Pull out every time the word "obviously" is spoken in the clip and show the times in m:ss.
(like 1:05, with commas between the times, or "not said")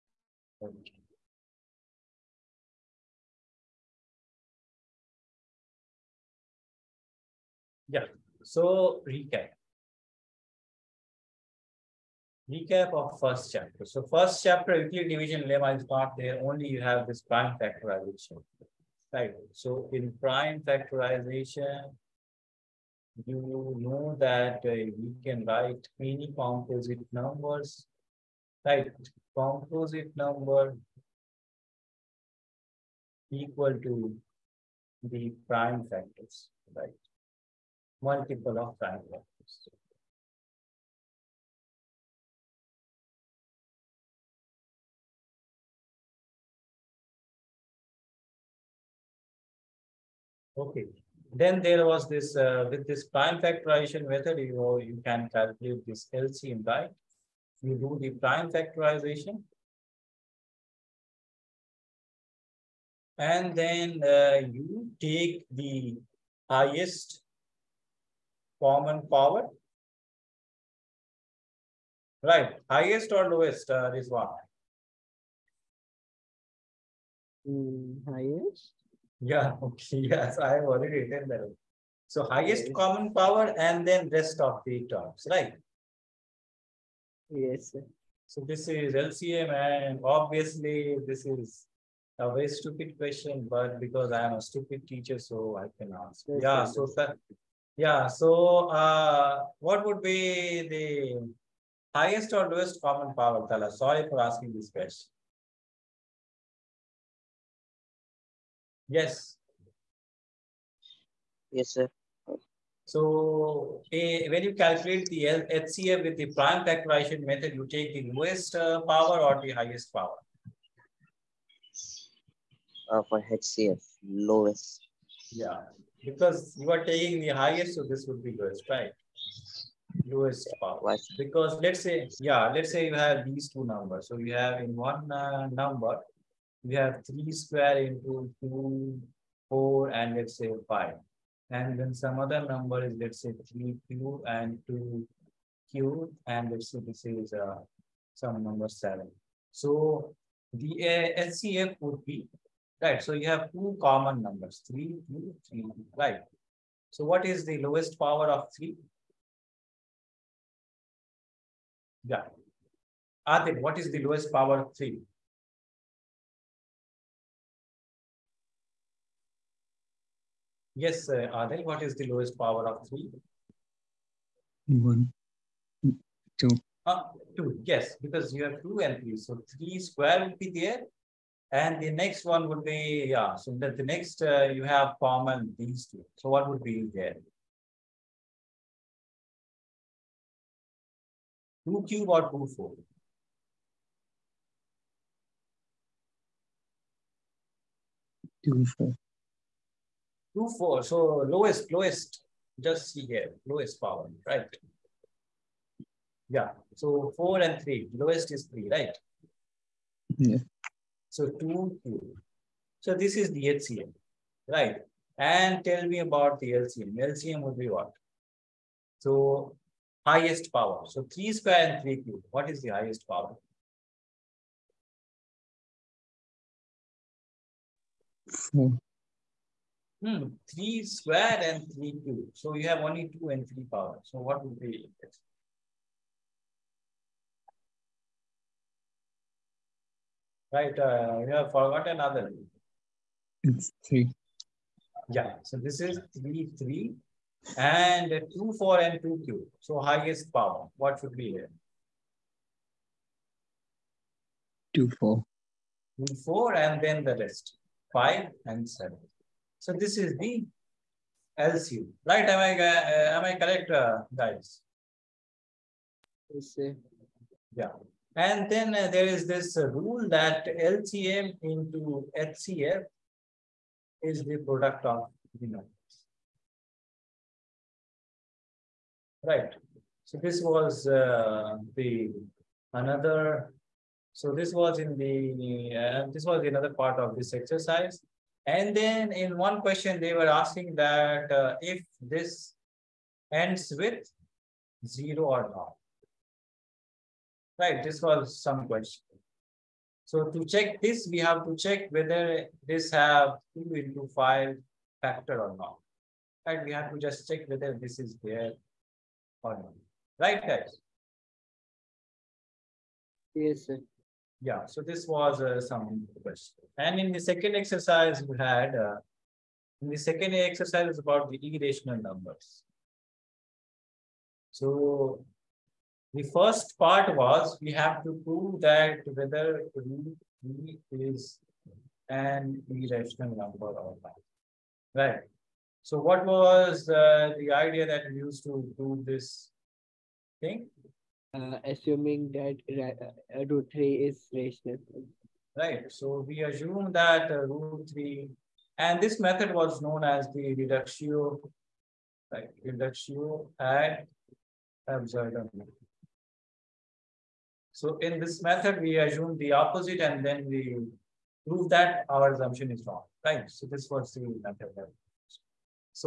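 1:30.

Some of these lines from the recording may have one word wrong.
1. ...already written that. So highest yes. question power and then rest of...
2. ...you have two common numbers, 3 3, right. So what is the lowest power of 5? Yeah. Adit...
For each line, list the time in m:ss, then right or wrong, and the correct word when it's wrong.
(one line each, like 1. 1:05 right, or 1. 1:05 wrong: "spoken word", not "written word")
1. 1:20 wrong: "common", not "question"
2. 2:33 wrong: "3", not "5".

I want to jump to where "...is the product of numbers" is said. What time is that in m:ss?
4:34.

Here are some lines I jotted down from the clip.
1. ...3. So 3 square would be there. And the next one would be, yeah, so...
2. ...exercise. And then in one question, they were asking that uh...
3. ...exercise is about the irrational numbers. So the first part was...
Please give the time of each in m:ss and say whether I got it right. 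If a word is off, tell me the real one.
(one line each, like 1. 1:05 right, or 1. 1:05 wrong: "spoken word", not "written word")
1. 2:59 right
2. 4:47 right
3. 5:20 right.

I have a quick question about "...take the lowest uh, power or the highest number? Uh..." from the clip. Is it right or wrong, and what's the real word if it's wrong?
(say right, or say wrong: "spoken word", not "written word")
wrong: "power", not "number".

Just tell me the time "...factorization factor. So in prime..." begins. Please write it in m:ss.
0:17.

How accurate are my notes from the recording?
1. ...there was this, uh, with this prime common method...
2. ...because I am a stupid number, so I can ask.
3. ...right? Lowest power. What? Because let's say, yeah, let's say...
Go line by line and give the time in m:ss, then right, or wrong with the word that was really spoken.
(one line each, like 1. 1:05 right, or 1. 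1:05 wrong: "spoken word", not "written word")
1. 0:51 wrong: "factorization", not "common"
2. 1:33 wrong: "teacher", not "number"
3. 2:08 right.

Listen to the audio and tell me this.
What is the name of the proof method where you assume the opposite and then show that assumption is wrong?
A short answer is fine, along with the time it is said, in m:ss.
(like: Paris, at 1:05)
Reductio ad absurdum, at 5:52.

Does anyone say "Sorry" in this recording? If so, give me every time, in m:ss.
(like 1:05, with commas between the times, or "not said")
1:43.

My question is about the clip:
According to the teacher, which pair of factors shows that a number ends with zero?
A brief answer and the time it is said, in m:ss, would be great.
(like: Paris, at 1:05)
2 into 5, at 5:03.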